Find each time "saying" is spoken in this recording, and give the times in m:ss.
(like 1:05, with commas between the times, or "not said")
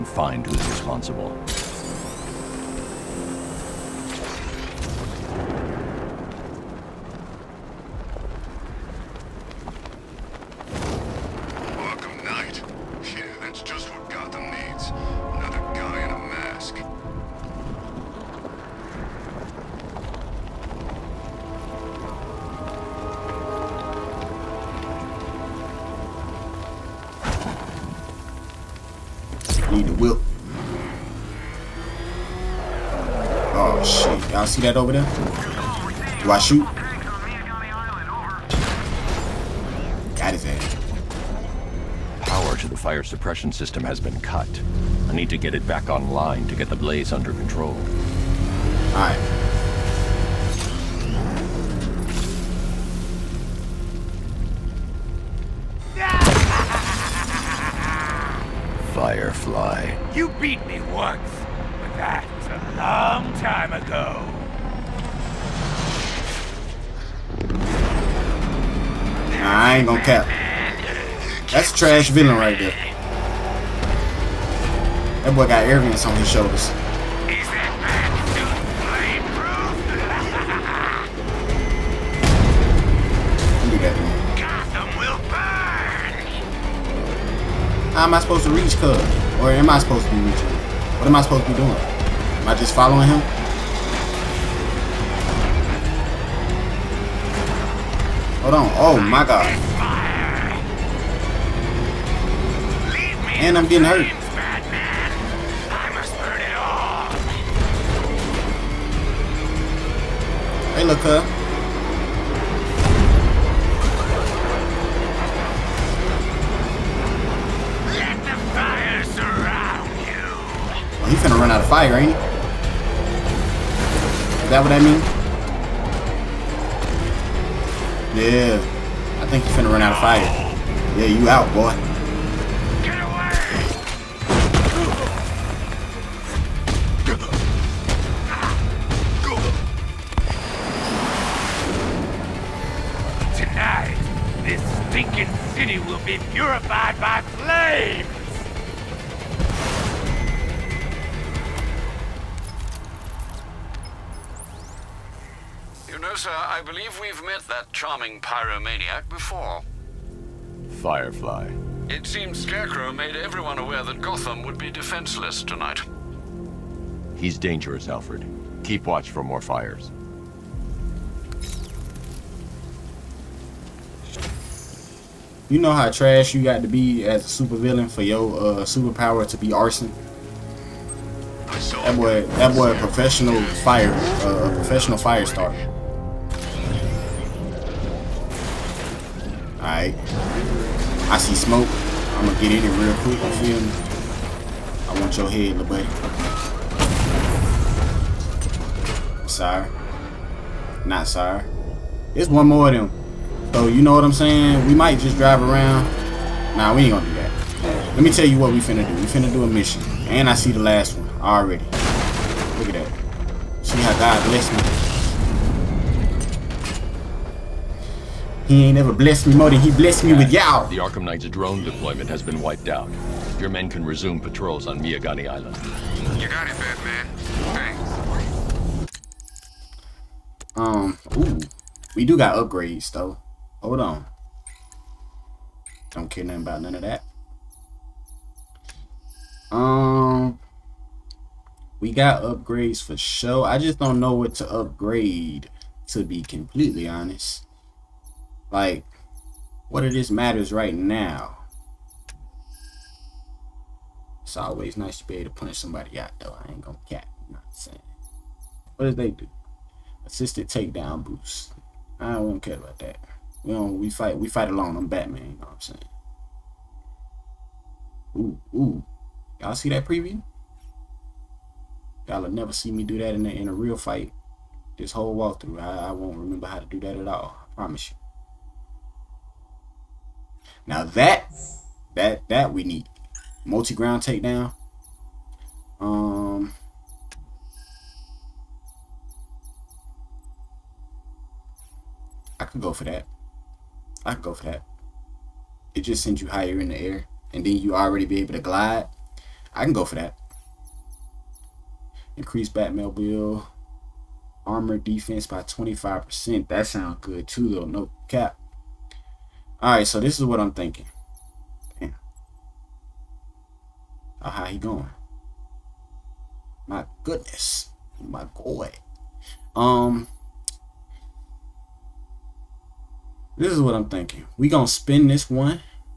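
3:24, 4:17, 4:25.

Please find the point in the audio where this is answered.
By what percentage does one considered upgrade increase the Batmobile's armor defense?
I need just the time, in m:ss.
5:05.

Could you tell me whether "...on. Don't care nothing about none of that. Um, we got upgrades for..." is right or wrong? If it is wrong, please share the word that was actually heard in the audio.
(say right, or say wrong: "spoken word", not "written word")
right.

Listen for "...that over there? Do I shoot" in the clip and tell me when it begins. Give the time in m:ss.
0:34.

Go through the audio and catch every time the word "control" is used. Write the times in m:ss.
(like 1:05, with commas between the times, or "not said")
0:47.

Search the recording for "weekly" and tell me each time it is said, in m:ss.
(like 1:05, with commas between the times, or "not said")
not said.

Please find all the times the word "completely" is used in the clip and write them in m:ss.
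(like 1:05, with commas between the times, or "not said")
4:06.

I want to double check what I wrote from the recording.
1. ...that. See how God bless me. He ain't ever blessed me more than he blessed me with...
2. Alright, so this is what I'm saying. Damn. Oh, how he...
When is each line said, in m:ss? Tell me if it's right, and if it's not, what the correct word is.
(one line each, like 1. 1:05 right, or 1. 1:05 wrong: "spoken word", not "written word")
1. 3:32 right
2. 5:09 wrong: "thinking", not "saying".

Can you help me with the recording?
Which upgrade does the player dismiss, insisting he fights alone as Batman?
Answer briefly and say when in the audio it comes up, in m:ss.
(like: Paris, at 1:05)
Assisted takedown boost, at 4:20.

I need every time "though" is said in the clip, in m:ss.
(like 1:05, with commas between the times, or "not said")
3:52, 4:16, 5:07.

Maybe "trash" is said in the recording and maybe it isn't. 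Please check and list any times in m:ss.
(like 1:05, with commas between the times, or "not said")
1:11, 2:55.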